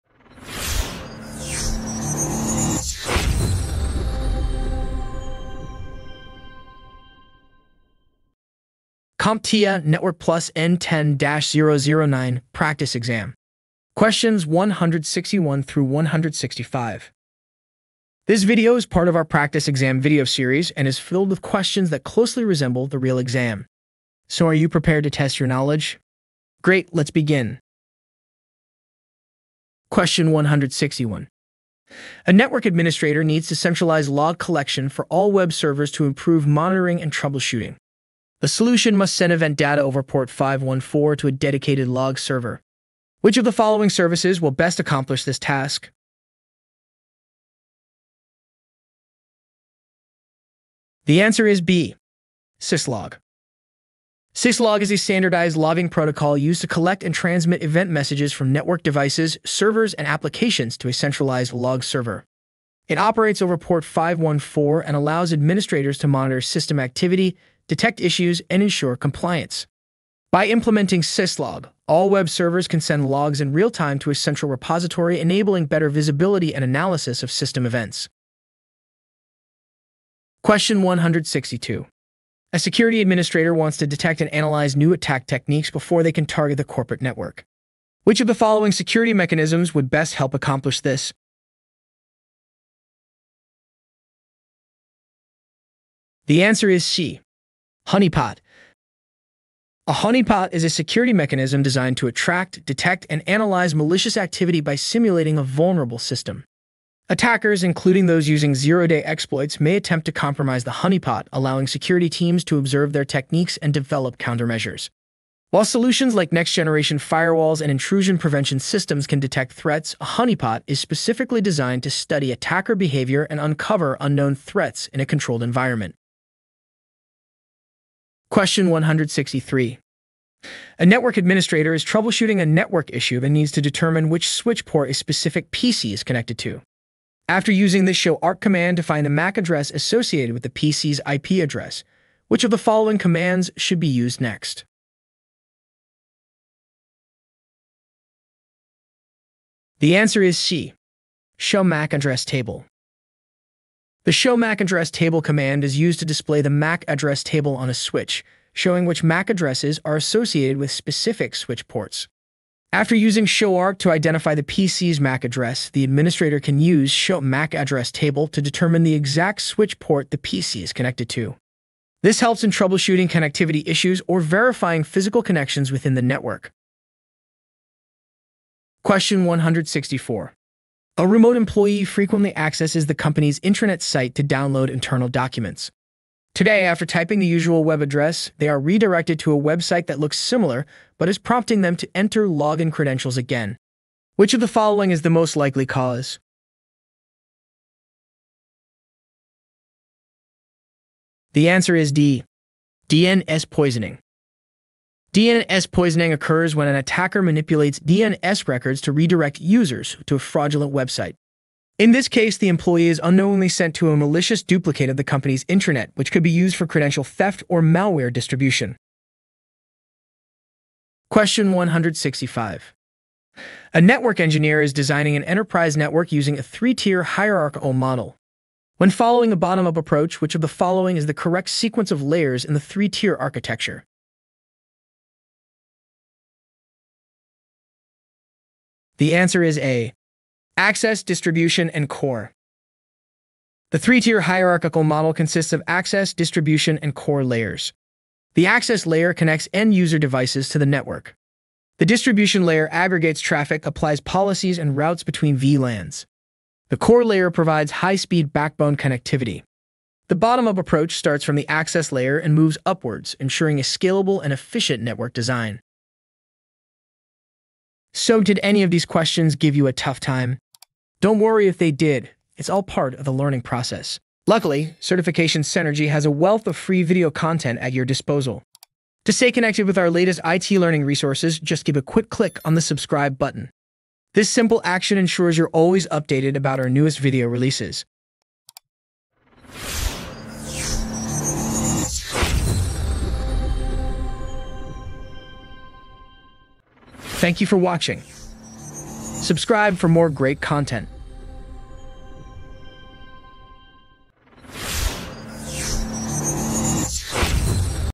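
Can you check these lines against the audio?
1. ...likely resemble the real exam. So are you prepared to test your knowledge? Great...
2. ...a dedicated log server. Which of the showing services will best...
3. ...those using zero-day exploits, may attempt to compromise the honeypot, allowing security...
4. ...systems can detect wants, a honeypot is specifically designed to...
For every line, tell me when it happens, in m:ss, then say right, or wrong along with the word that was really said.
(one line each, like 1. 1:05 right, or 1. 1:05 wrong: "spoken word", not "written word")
1. 0:22 wrong: "closely", not "likely"
2. 0:41 wrong: "following", not "showing"
3. 1:48 right
4. 1:58 wrong: "threats", not "wants".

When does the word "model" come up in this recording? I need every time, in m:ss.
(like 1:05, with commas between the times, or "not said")
3:47, 4:04.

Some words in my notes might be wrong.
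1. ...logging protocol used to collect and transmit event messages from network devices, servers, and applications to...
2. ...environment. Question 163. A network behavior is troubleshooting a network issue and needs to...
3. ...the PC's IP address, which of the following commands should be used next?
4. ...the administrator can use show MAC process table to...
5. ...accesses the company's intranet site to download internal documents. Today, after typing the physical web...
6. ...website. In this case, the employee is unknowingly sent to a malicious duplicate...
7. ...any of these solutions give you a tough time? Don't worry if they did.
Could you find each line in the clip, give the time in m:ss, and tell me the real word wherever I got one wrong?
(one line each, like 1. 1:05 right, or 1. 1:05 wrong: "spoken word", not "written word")
1. 0:55 right
2. 2:05 wrong: "administrator", not "behavior"
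3. 2:20 right
4. 2:45 wrong: "address", not "process"
5. 3:02 wrong: "usual", not "physical"
6. 3:30 right
7. 4:28 wrong: "questions", not "solutions".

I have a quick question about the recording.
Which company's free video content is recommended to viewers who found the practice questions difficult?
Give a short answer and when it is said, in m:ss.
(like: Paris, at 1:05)
Certification Cynergy, at 4:34.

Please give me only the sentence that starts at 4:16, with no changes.
The core layer provides high-speed backbone connectivity.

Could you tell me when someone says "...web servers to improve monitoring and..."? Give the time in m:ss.
0:35.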